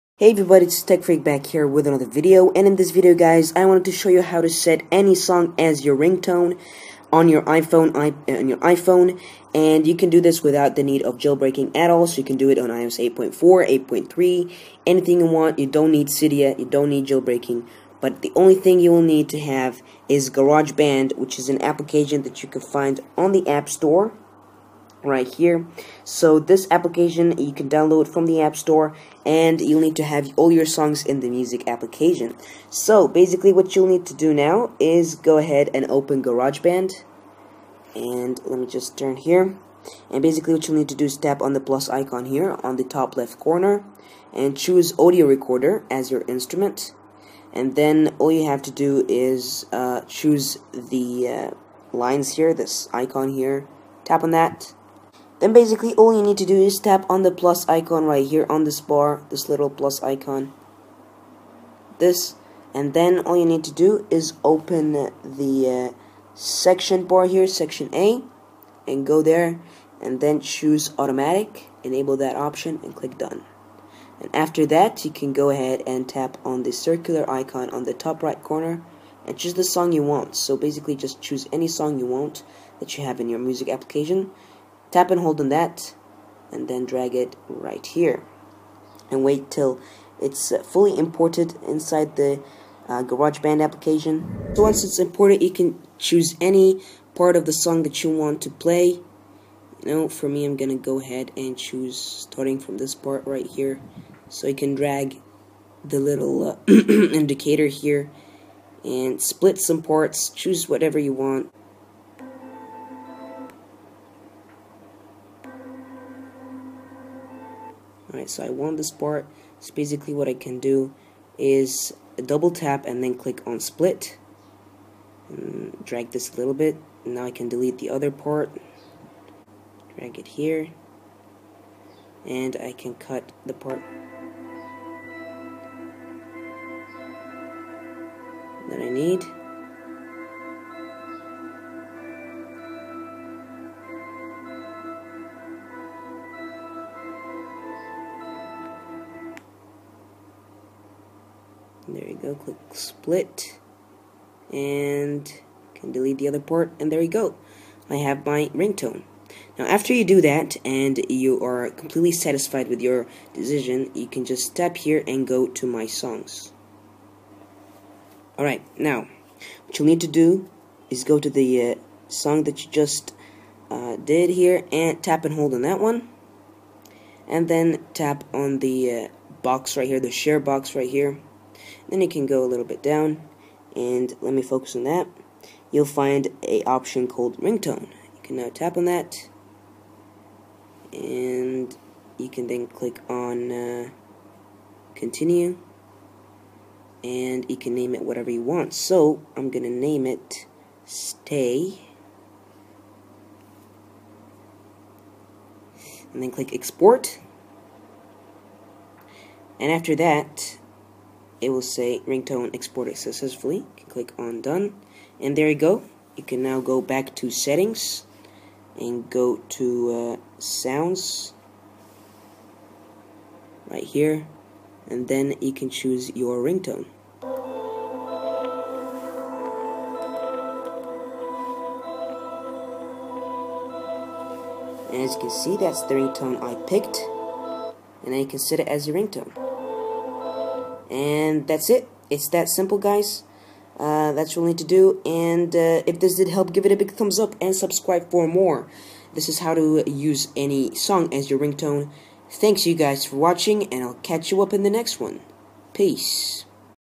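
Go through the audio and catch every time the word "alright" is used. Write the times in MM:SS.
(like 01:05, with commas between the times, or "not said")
01:58, 02:48.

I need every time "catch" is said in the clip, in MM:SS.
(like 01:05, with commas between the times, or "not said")
04:13.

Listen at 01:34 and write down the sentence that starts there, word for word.
So once it's imported, you can choose any part of the song that you want to play.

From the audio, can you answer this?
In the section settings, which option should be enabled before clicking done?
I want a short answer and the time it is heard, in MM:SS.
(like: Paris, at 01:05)
automatic, at 01:10.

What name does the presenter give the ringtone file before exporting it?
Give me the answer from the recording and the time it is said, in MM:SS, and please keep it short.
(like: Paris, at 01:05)
stay, at 03:20.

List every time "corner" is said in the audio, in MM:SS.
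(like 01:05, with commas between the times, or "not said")
00:43, 01:18.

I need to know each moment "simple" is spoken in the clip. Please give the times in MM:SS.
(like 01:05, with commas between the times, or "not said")
04:02.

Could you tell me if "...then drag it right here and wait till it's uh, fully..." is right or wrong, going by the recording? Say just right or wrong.
right.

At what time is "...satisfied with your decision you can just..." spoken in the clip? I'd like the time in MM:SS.
02:42.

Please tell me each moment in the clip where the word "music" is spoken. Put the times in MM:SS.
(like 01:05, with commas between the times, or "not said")
00:31, 01:23.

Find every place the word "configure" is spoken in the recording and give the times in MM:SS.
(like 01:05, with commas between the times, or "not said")
not said.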